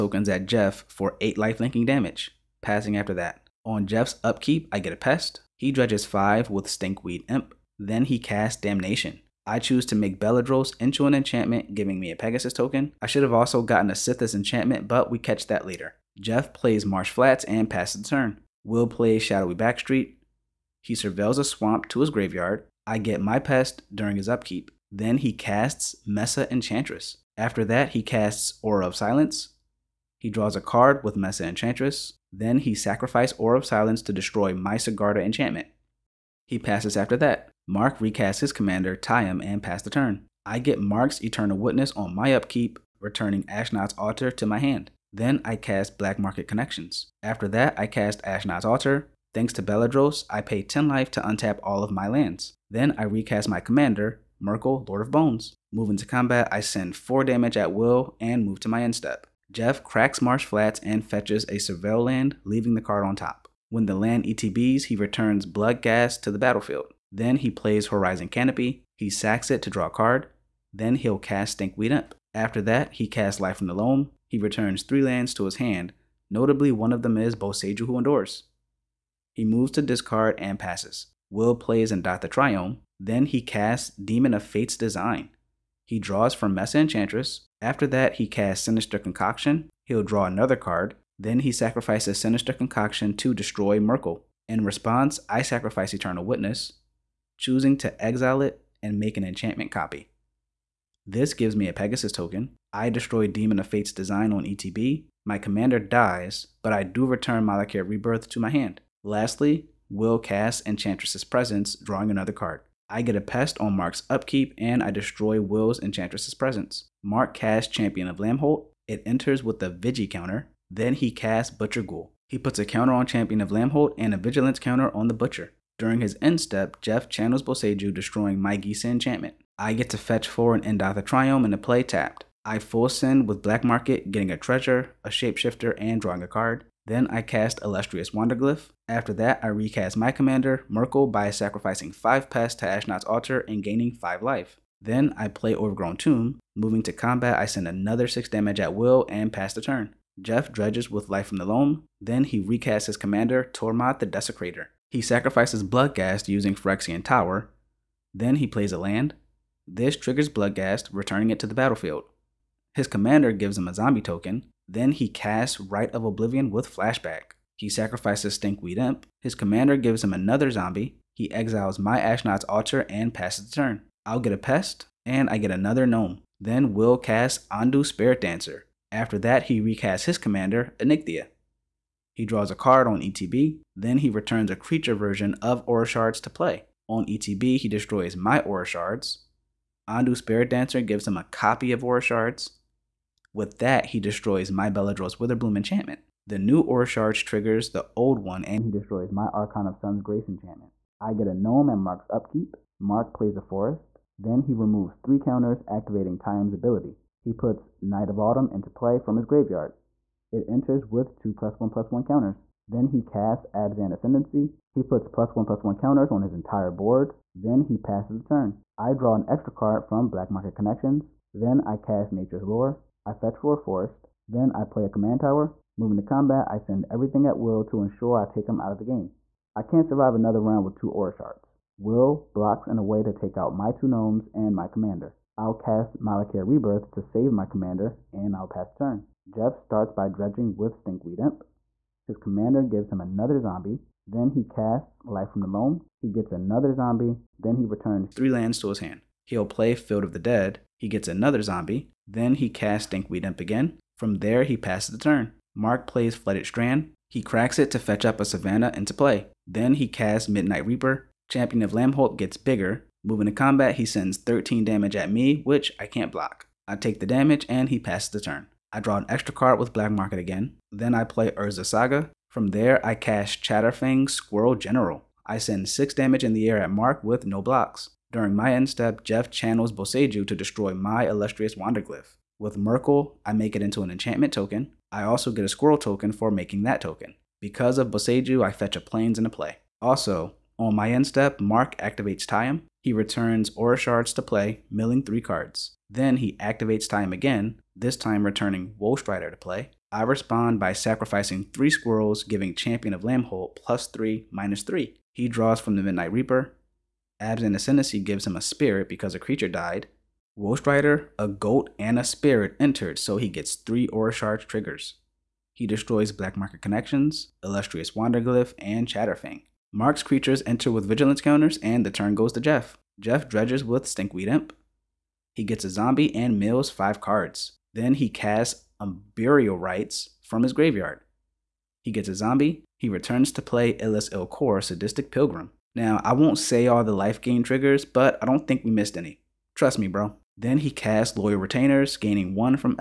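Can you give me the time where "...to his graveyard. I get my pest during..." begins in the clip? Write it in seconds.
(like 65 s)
21 s.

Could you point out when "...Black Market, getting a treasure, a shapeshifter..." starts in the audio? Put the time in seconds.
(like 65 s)
133 s.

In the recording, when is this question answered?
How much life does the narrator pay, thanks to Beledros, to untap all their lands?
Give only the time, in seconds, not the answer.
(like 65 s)
50 s.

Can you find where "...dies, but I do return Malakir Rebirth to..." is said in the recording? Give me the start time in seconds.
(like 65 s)
105 s.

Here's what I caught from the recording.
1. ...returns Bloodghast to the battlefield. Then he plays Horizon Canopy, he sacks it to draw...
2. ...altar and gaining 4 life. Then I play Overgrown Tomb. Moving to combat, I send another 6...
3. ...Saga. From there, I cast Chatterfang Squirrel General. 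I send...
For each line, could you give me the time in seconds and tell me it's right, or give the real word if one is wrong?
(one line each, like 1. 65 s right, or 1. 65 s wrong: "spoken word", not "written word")
1. 64 s right
2. 143 s wrong: "5", not "4"
3. 271 s right.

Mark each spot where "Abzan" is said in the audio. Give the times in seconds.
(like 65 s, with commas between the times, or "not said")
213 s, 307 s.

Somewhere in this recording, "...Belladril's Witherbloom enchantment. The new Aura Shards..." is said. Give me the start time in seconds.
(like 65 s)
194 s.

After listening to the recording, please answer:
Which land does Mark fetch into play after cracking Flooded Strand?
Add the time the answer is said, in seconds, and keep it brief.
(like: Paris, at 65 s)
Savannah, at 258 s.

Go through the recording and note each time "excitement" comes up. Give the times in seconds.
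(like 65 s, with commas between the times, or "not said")
not said.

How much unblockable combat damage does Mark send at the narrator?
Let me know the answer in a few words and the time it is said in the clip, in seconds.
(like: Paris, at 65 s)
13, at 264 s.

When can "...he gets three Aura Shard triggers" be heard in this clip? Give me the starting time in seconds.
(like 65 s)
313 s.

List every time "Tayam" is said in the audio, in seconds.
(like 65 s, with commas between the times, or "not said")
38 s, 206 s, 292 s, 296 s.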